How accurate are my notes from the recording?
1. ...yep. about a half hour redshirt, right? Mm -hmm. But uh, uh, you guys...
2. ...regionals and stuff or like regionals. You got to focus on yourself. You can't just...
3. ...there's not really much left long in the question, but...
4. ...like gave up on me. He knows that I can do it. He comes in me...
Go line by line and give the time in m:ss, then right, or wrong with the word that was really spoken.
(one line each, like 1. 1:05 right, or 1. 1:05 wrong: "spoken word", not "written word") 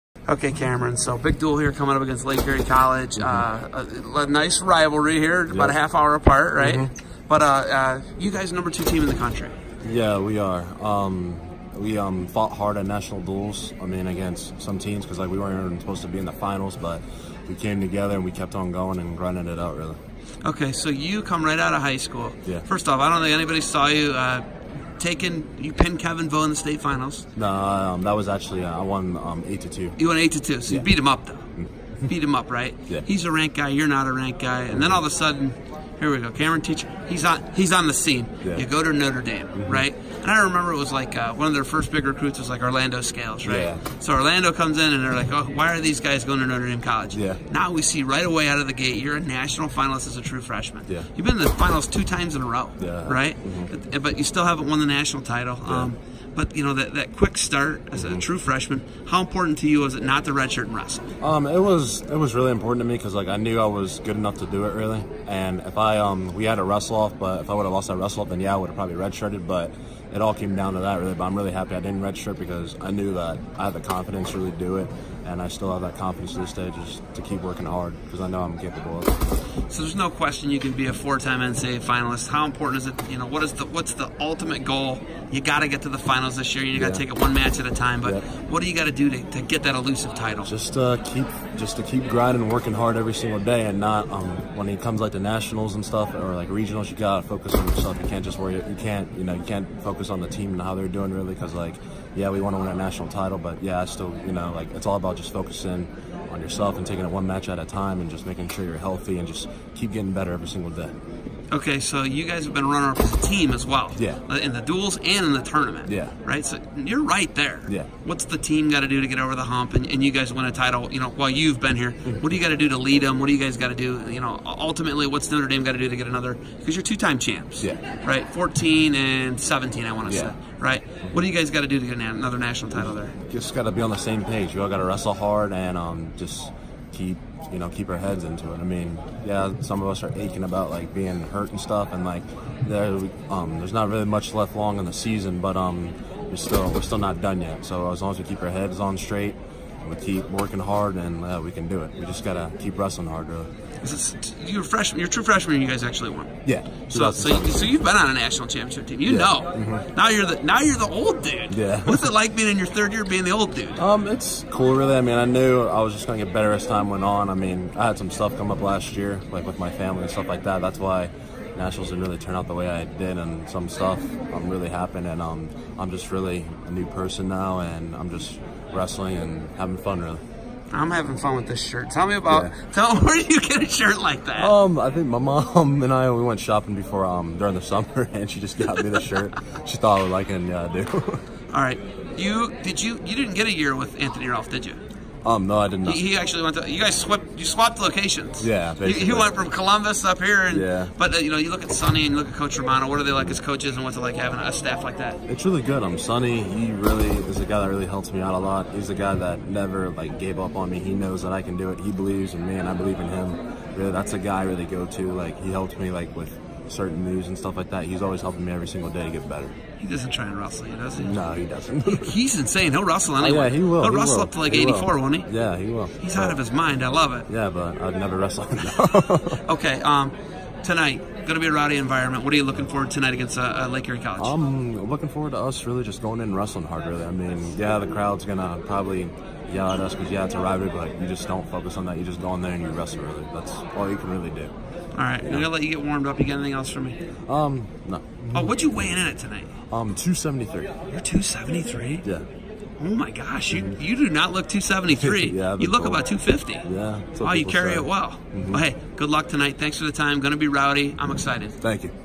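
1. 0:05 wrong: "apart", not "redshirt"
2. 1:35 wrong: "nationals", not "regionals"
3. 2:23 wrong: "season", not "question"
4. 3:29 wrong: "believes", not "comes".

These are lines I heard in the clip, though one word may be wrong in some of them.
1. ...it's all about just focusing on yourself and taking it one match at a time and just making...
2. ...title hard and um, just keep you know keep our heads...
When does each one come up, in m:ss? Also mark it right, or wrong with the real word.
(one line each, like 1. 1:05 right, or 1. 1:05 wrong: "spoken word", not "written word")
1. 1:44 right
2. 2:14 wrong: "wrestle", not "title".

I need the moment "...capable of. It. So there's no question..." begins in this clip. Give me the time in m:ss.
1:18.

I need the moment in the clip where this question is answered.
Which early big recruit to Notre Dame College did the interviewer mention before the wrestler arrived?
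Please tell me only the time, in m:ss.
0:42.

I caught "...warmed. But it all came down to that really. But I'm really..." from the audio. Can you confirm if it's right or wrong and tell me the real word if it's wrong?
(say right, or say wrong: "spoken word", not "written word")
wrong: "redshirted", not "warmed".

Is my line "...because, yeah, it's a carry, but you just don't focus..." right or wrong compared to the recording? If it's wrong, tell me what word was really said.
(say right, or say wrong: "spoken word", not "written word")
wrong: "rivalry", not "carry".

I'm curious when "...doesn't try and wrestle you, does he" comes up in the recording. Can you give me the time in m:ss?
3:39.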